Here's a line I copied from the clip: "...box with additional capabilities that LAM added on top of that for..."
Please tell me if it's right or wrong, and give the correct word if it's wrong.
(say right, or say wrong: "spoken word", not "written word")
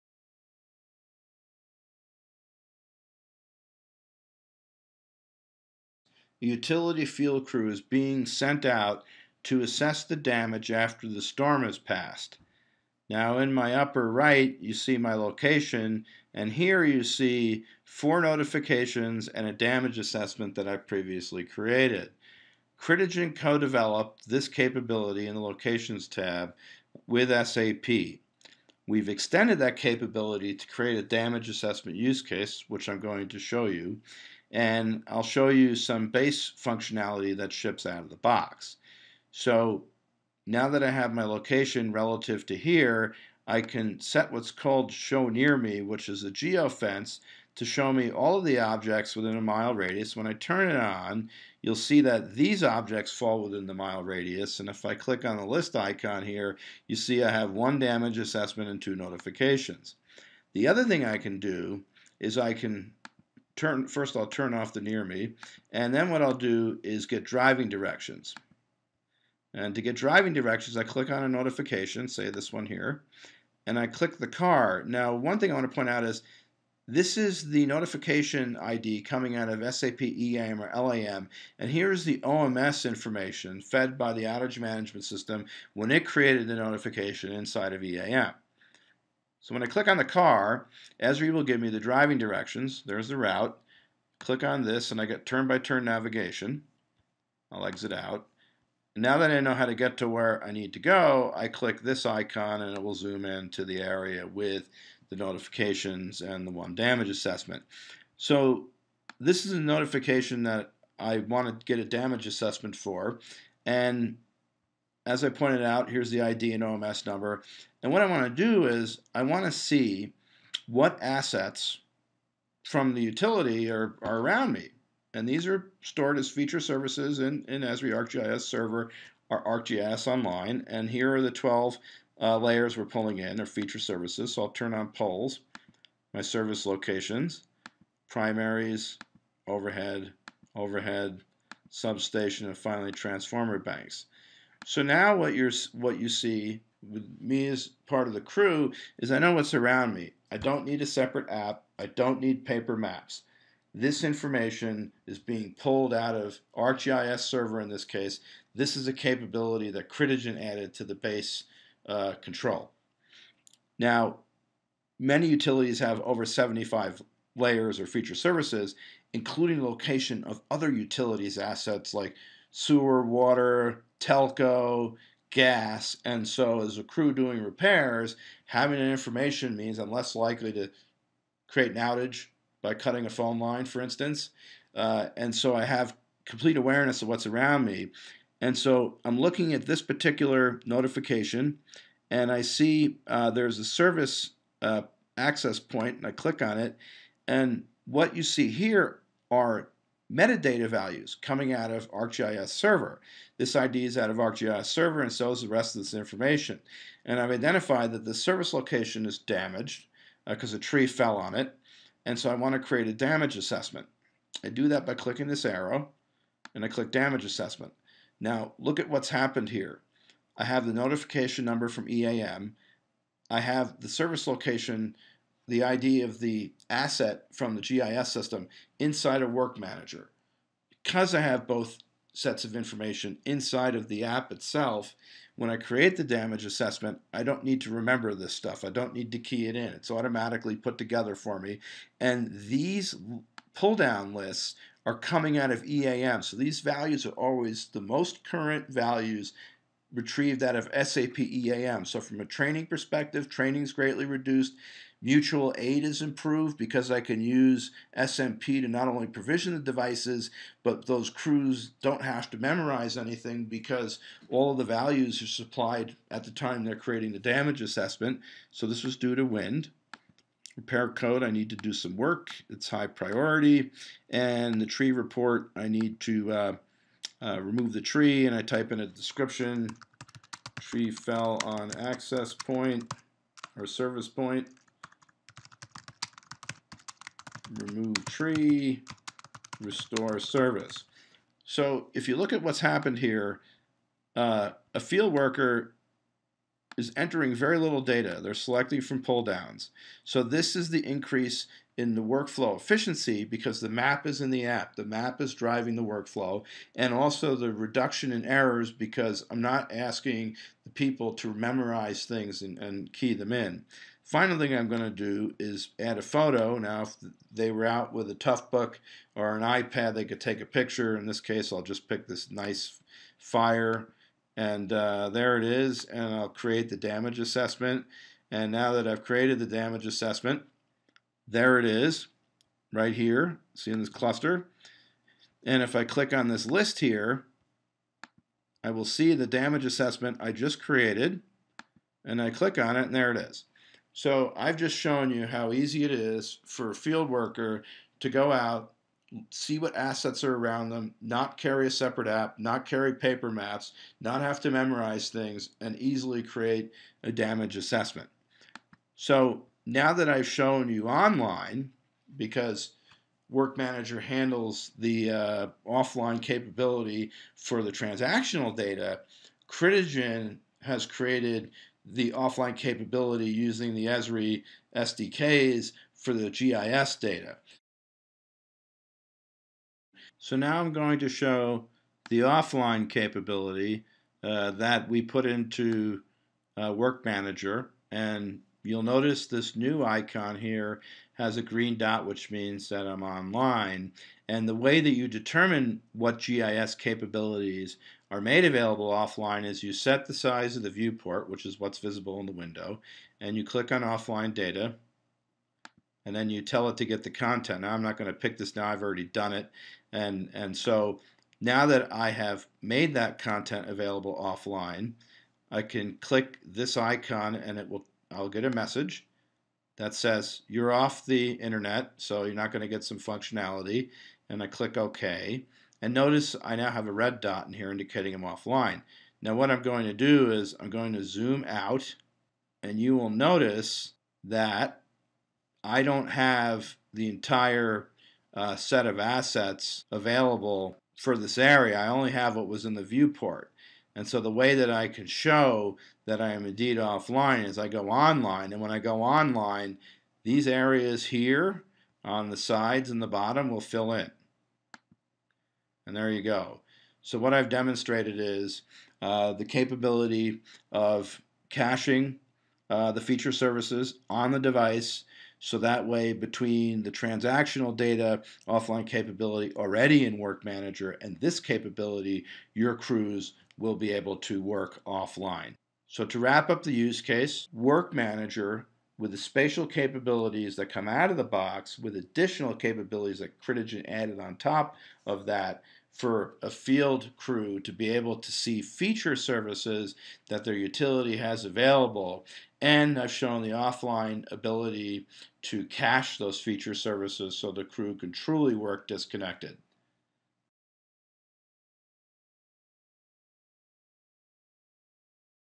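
wrong: "Critigen", not "LAM".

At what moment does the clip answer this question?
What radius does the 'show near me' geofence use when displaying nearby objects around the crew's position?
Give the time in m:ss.
0:49.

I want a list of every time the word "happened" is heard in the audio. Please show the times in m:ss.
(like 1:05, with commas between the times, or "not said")
3:39, 4:52.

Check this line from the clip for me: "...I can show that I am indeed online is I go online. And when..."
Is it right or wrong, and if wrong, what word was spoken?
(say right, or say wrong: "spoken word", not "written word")
wrong: "offline", not "online".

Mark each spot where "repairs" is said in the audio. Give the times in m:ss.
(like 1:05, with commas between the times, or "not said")
2:57, 4:30.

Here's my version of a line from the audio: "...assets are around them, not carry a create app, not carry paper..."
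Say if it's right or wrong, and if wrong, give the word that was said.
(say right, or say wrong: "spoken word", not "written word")
wrong: "separate", not "create".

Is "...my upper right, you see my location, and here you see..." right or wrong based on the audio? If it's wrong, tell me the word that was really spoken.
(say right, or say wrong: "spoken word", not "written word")
right.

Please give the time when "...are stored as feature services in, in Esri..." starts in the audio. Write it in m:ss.
2:05.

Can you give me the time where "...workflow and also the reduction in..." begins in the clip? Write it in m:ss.
5:05.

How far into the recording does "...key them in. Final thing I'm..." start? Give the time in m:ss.
5:12.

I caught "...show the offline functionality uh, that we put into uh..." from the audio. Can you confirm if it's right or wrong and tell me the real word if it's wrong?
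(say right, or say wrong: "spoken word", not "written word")
wrong: "capability", not "functionality".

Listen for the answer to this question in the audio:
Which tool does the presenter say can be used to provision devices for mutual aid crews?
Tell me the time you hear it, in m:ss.
4:17.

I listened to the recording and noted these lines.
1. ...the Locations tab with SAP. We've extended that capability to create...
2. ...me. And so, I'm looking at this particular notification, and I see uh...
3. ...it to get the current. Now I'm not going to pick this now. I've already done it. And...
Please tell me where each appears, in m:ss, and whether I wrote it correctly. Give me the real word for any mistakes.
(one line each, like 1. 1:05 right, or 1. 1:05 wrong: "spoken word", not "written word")
1. 0:25 right
2. 3:07 right
3. 6:46 wrong: "content", not "current".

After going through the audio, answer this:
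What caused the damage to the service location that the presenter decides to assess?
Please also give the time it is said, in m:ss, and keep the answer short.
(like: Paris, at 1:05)
A tree fell on it, at 3:30.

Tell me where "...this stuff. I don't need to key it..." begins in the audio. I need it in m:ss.
3:58.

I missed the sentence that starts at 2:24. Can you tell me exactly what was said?
So now what you're what you see with me as part of the crew is I know what's around me.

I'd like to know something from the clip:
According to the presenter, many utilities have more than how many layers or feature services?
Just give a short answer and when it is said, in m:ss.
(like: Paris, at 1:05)
75, at 2:46.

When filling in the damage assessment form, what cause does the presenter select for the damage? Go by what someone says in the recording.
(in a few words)
Wind.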